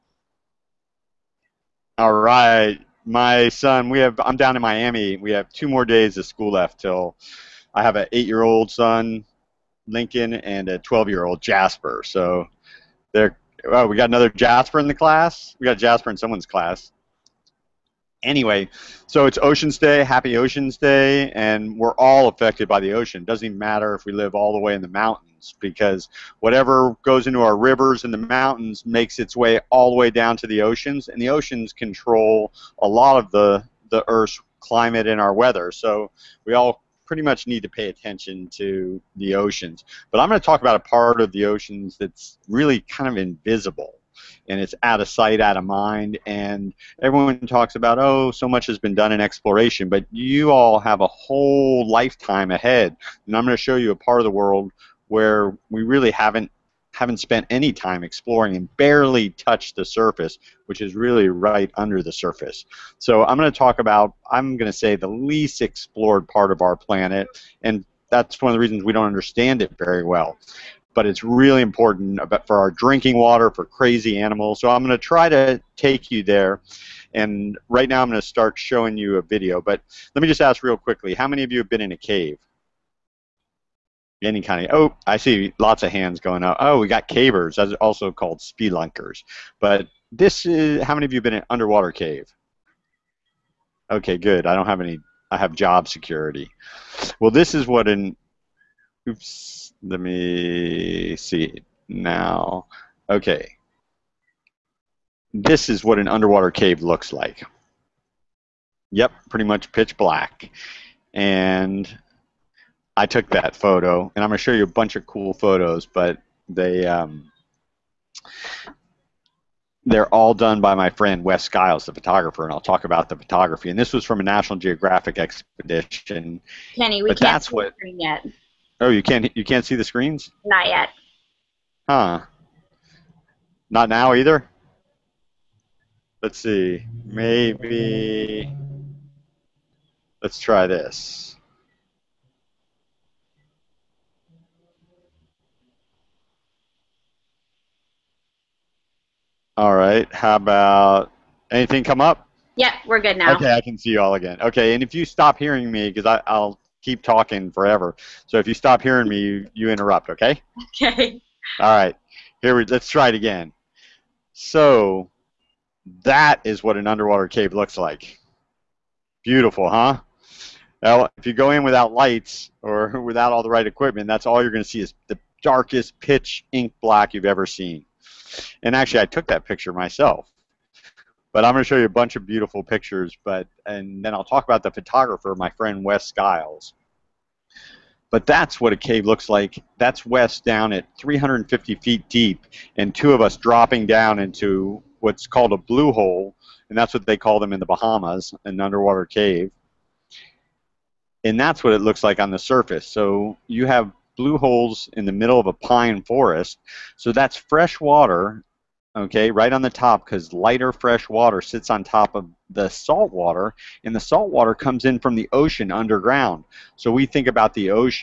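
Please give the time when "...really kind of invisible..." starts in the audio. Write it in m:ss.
0:42.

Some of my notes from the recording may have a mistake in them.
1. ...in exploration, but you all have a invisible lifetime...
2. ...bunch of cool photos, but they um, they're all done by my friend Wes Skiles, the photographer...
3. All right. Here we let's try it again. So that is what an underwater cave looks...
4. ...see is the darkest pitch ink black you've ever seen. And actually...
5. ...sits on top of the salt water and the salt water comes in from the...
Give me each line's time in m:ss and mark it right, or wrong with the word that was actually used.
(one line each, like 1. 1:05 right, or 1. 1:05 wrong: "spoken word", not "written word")
1. 0:49 wrong: "whole", not "invisible"
2. 1:54 right
3. 2:41 right
4. 2:54 right
5. 3:31 right.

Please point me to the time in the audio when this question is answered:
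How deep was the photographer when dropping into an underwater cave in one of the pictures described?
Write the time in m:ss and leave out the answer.
3:10.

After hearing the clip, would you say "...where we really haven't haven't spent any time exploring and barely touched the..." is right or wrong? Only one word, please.
right.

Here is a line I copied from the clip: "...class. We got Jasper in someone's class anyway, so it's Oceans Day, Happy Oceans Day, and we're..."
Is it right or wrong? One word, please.
right.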